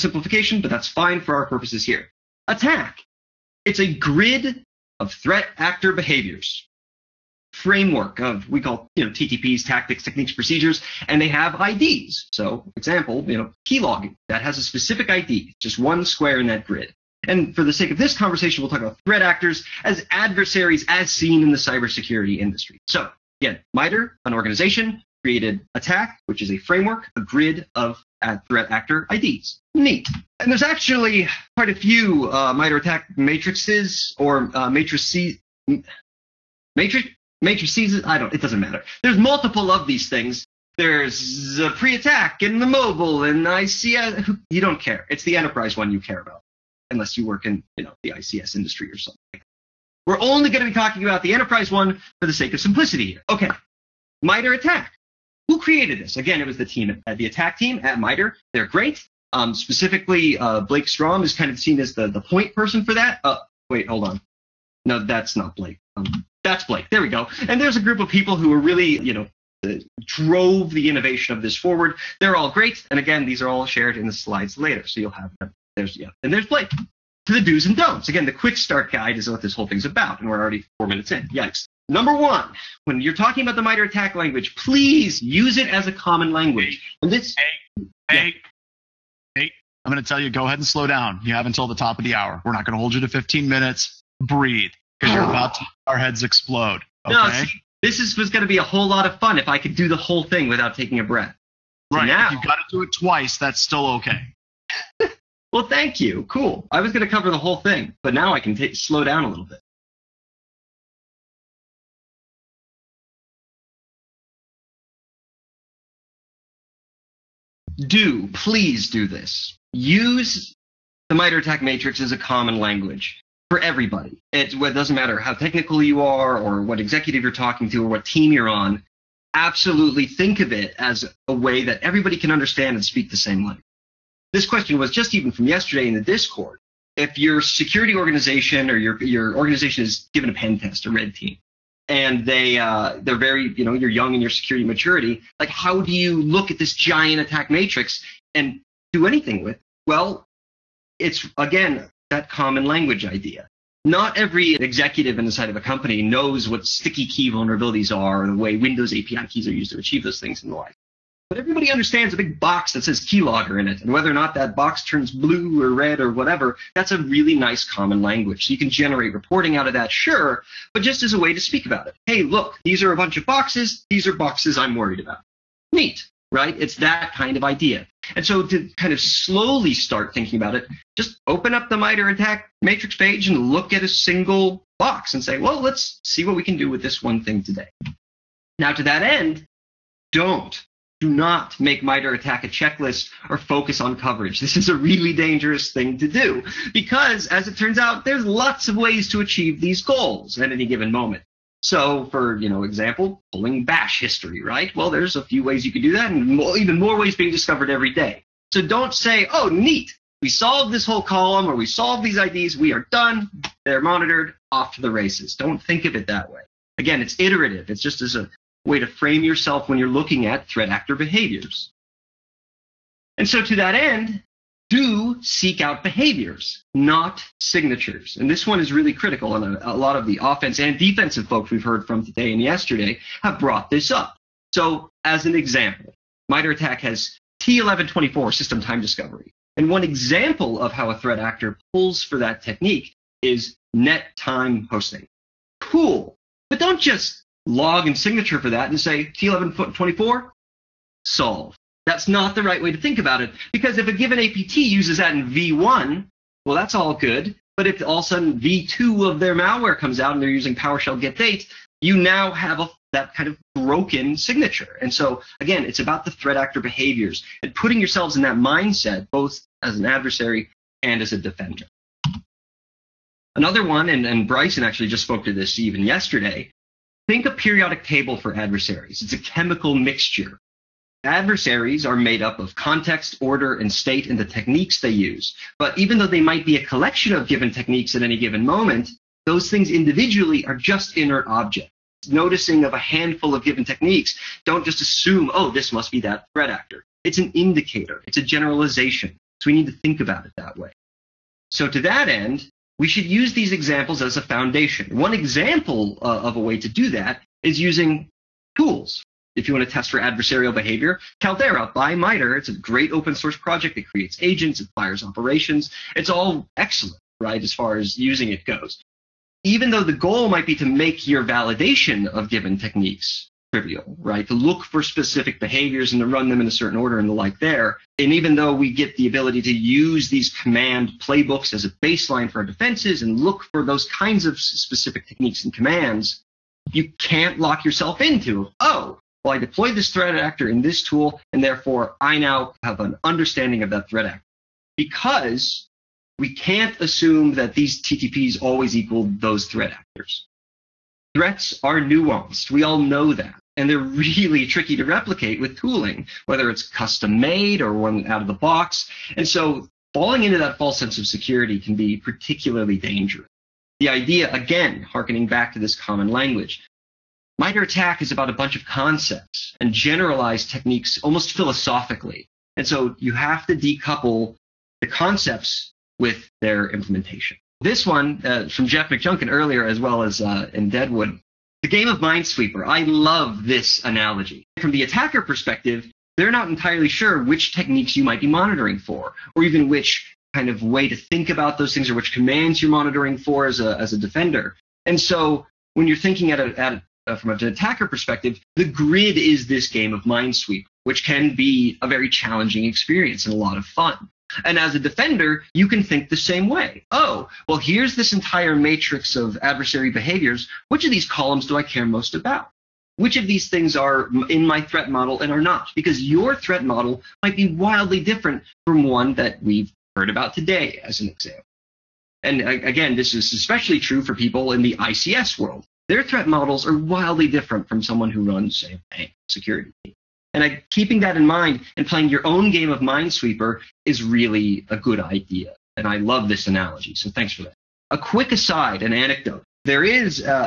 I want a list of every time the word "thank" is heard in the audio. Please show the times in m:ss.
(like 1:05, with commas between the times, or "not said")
1:45, 7:17.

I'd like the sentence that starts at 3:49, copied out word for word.
And a, a, lot of the offense and defensive folks we've heard from today and yesterday have brought this up.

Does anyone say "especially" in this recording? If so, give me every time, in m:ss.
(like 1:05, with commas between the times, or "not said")
7:03.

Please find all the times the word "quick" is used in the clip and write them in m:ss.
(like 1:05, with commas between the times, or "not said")
1:18, 7:17.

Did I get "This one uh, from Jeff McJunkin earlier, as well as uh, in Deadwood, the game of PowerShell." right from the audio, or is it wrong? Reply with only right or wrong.
wrong.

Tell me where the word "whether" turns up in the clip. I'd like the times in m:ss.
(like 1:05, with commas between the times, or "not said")
2:43, 5:56.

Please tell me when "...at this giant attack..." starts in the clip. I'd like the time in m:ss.
2:26.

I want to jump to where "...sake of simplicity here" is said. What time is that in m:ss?
0:52.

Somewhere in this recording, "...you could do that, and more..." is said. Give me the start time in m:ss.
3:25.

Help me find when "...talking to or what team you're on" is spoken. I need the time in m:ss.
2:07.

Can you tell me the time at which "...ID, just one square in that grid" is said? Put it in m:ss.
0:15.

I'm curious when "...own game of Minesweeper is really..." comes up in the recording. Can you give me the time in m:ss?
7:12.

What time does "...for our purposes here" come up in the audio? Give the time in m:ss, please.
0:01.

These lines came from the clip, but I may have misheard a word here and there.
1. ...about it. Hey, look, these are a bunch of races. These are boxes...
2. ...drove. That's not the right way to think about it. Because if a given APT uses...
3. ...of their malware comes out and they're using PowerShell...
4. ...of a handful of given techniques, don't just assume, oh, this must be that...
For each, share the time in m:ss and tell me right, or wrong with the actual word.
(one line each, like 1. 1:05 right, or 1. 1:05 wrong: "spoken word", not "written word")
1. 2:51 wrong: "boxes", not "races"
2. 4:11 wrong: "solve", not "drove"
3. 4:19 right
4. 4:52 right.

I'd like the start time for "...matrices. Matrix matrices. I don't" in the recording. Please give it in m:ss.
0:34.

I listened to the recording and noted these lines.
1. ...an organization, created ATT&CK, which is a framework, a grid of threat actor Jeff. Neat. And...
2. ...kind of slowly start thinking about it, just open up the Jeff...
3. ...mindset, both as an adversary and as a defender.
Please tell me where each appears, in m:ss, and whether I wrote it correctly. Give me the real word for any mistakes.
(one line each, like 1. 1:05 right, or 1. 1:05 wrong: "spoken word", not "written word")
1. 0:24 wrong: "IDs", not "Jeff"
2. 2:58 wrong: "MITRE", not "Jeff"
3. 4:28 right.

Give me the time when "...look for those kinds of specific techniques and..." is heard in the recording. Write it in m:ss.
5:33.